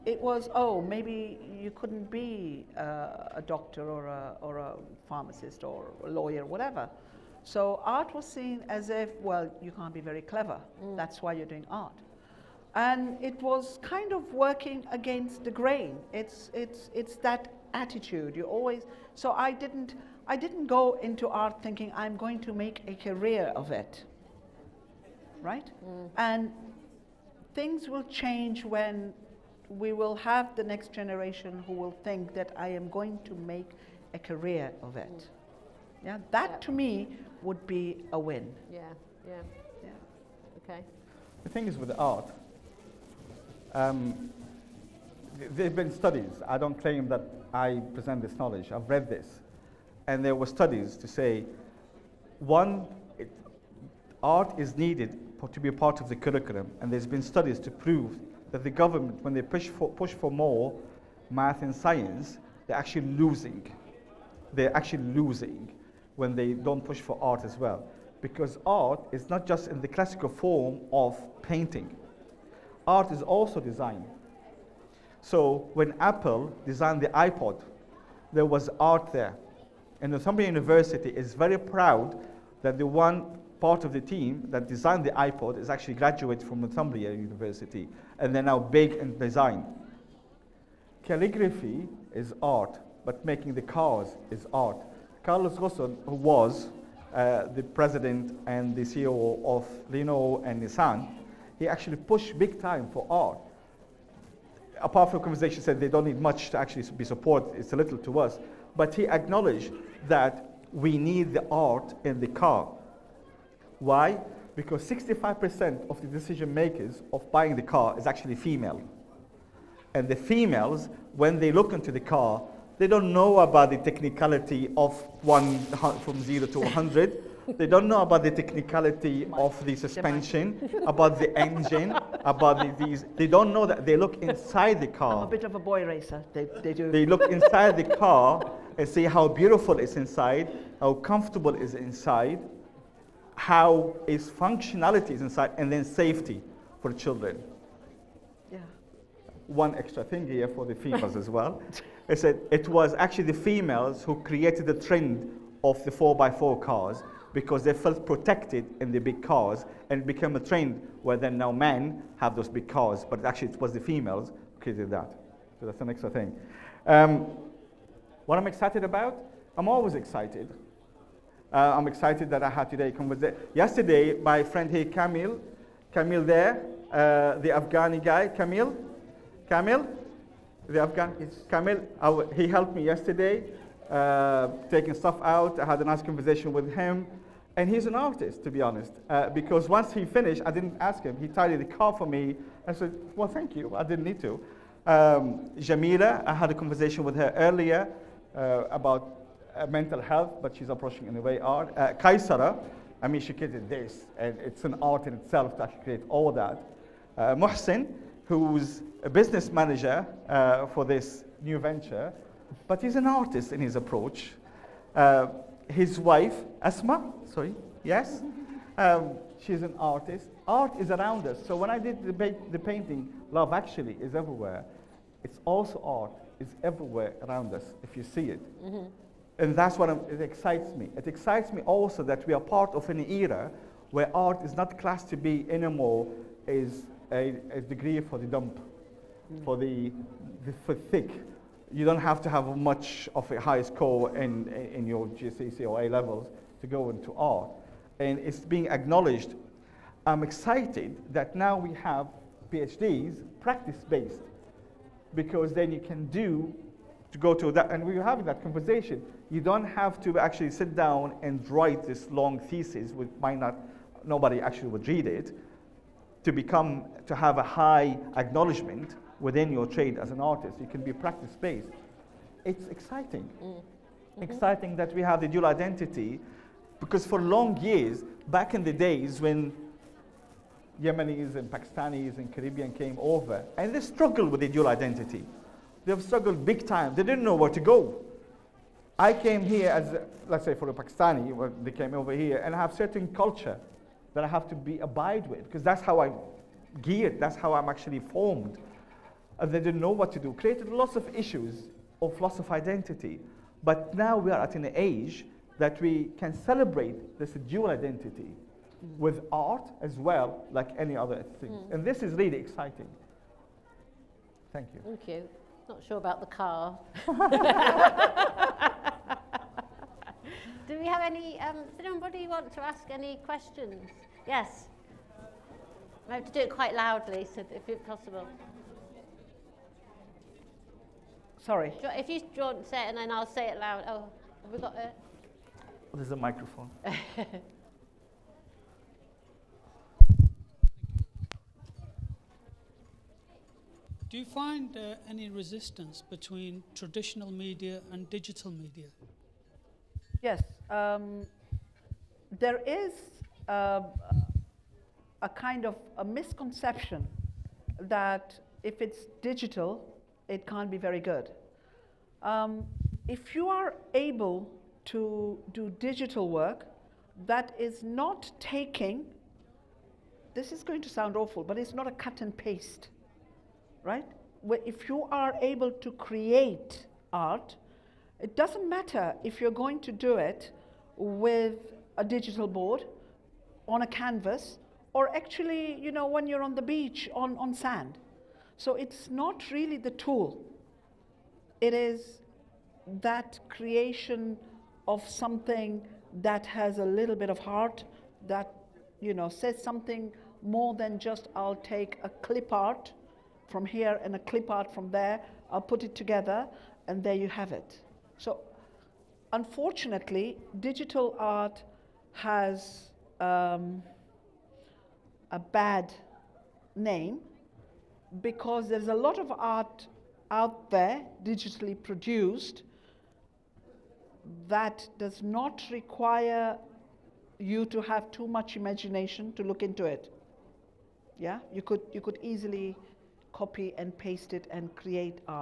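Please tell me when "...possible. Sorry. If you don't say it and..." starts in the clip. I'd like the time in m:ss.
5:27.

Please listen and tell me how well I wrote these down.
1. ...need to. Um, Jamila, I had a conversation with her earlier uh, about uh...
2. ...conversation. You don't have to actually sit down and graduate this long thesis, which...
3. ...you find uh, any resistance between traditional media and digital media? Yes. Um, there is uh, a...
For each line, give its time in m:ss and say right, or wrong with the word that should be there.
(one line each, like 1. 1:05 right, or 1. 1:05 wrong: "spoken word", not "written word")
1. 3:14 right
2. 4:18 wrong: "write", not "graduate"
3. 5:44 right.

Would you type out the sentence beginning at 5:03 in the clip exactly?
But now we are at an age that we can celebrate this dual identity mm.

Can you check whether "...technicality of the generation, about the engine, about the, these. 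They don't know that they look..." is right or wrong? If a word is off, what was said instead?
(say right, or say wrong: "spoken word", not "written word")
wrong: "suspension", not "generation".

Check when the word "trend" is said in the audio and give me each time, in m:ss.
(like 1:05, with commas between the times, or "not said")
2:34, 2:40.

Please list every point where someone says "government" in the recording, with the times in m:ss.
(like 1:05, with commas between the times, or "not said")
0:58.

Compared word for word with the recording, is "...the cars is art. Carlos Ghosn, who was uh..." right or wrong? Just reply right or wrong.
right.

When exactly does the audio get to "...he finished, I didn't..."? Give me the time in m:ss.
3:09.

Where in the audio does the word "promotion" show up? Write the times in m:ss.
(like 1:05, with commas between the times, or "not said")
not said.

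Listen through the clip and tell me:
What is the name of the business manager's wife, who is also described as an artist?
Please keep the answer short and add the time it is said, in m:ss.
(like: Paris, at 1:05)
Asma, at 3:36.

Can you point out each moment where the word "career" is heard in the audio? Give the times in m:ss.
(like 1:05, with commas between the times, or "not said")
0:22, 0:34.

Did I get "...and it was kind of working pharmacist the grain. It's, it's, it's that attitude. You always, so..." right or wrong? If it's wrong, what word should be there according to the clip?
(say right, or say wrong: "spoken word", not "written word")
wrong: "against", not "pharmacist".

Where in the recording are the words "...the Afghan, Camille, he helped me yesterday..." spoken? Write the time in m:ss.
3:00.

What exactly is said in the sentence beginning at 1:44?
A powerful conversation said they don't need much to actually be support, it's a little to us.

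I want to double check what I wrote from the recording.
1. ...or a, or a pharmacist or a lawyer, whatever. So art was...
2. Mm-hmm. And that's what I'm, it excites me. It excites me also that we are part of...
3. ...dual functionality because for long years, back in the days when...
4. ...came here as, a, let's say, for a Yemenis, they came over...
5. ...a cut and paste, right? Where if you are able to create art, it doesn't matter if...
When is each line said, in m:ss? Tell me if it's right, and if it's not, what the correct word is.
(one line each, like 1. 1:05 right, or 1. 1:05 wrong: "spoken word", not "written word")
1. 0:03 right
2. 3:48 right
3. 4:35 wrong: "identity", not "functionality"
4. 4:49 wrong: "Pakistani", not "Yemenis"
5. 6:11 right.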